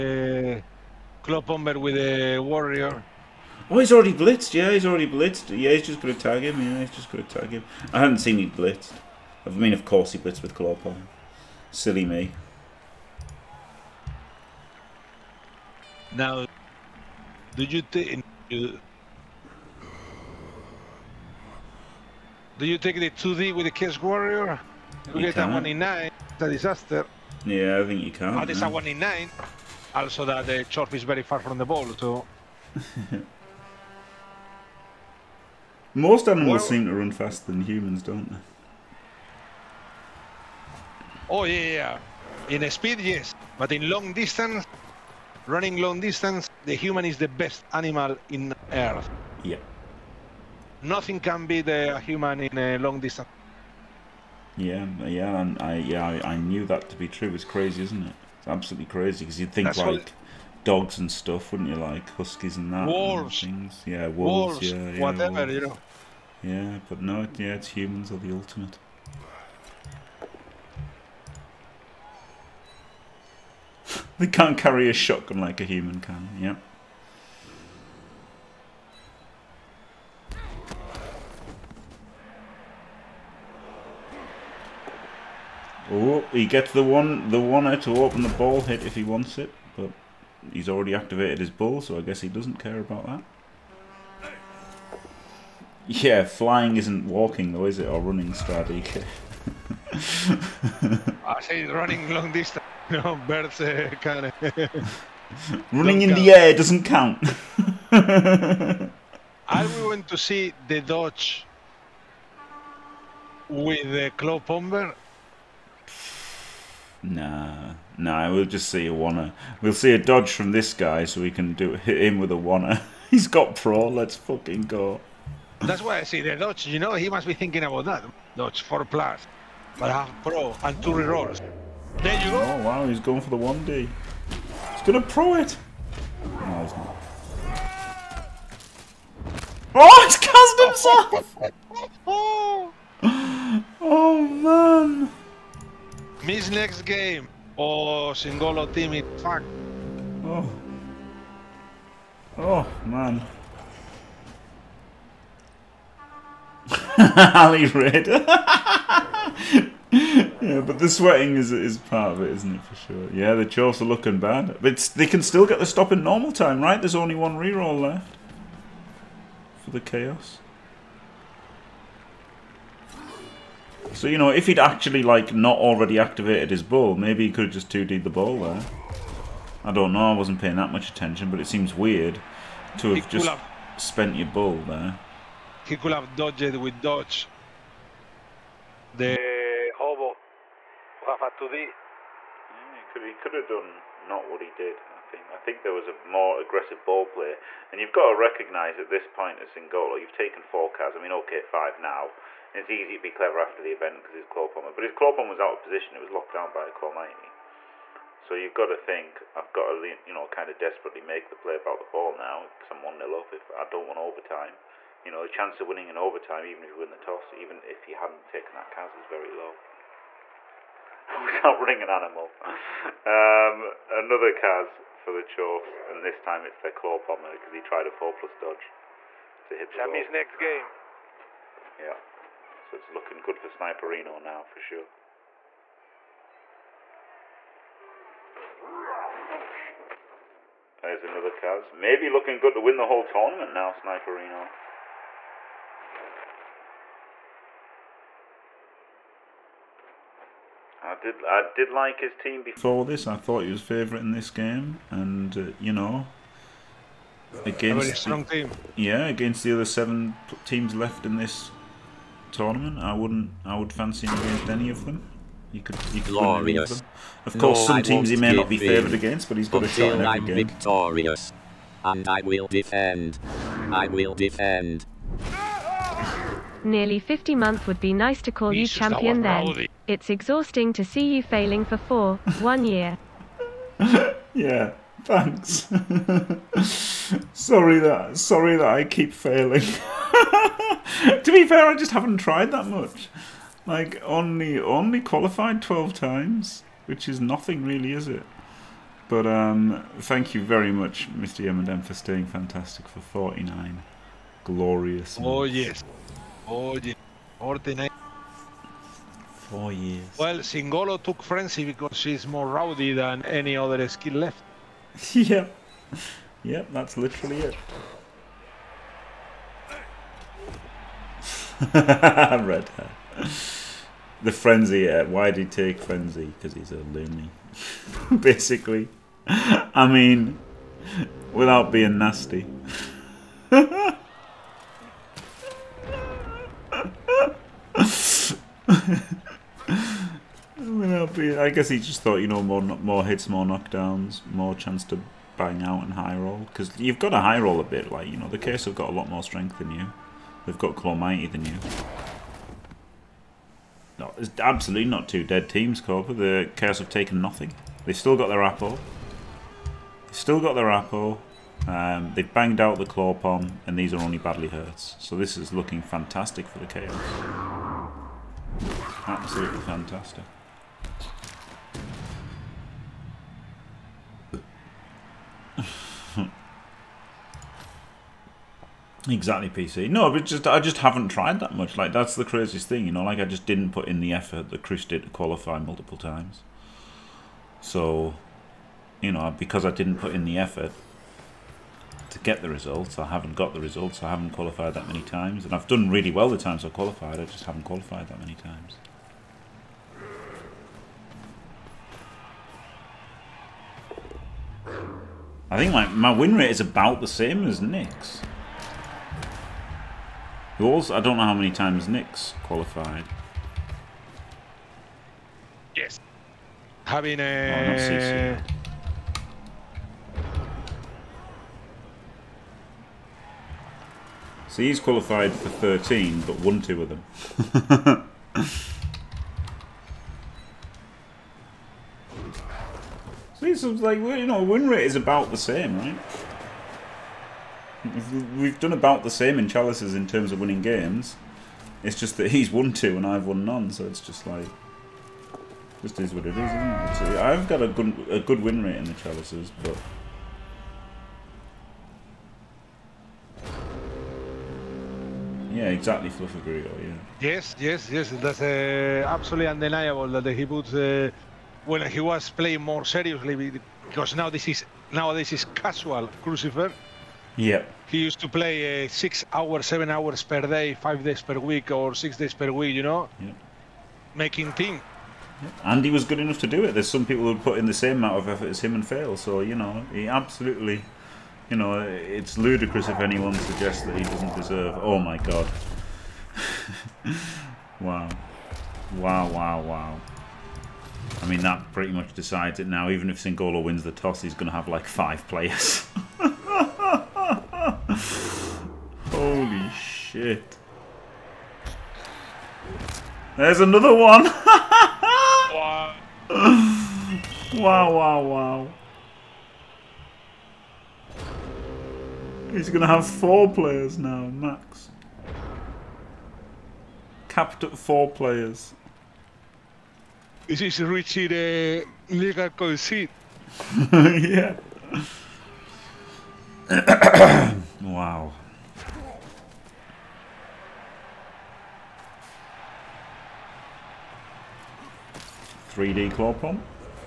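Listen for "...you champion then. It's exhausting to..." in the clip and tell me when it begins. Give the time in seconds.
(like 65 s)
278 s.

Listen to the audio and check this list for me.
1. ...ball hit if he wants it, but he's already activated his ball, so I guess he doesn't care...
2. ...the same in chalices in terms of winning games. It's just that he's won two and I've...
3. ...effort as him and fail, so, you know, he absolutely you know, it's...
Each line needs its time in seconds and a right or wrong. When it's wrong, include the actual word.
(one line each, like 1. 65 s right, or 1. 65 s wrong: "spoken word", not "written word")
1. 88 s right
2. 439 s right
3. 478 s right.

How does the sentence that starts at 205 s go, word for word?
It was locked down by a claw So you've got to think.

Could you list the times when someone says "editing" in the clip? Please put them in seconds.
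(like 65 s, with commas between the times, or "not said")
not said.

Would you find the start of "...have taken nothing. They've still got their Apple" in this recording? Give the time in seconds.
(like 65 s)
356 s.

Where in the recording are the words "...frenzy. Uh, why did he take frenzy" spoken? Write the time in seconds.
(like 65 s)
324 s.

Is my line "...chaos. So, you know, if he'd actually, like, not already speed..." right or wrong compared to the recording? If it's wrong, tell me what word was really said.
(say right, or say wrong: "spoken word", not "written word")
wrong: "activated", not "speed".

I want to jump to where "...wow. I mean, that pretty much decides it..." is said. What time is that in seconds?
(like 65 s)
489 s.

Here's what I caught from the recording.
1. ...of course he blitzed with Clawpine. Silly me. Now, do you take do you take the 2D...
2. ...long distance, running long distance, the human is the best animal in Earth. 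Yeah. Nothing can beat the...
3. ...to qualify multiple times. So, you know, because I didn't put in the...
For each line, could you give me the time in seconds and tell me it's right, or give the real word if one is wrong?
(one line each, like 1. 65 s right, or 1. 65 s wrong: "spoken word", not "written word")
1. 9 s right
2. 43 s right
3. 385 s right.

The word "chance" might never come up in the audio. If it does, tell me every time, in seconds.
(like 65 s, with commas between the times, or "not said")
215 s, 344 s.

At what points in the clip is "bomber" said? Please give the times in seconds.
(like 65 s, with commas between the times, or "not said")
1 s, 114 s.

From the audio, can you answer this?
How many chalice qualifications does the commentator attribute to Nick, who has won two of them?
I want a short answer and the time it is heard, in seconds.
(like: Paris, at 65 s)
13, at 425 s.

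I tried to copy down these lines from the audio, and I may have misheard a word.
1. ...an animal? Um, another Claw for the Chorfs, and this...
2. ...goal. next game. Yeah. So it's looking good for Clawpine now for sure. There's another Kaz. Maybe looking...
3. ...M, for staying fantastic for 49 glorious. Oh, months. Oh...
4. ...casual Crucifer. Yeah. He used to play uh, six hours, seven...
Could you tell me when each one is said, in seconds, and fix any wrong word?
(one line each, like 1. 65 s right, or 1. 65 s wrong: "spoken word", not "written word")
1. 221 s wrong: "Kaz", not "Claw"
2. 230 s wrong: "Sniperino", not "Clawpine"
3. 301 s right
4. 465 s right.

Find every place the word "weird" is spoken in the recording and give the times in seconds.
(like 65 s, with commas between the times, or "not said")
181 s.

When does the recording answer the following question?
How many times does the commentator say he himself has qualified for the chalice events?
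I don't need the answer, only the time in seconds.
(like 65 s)
295 s.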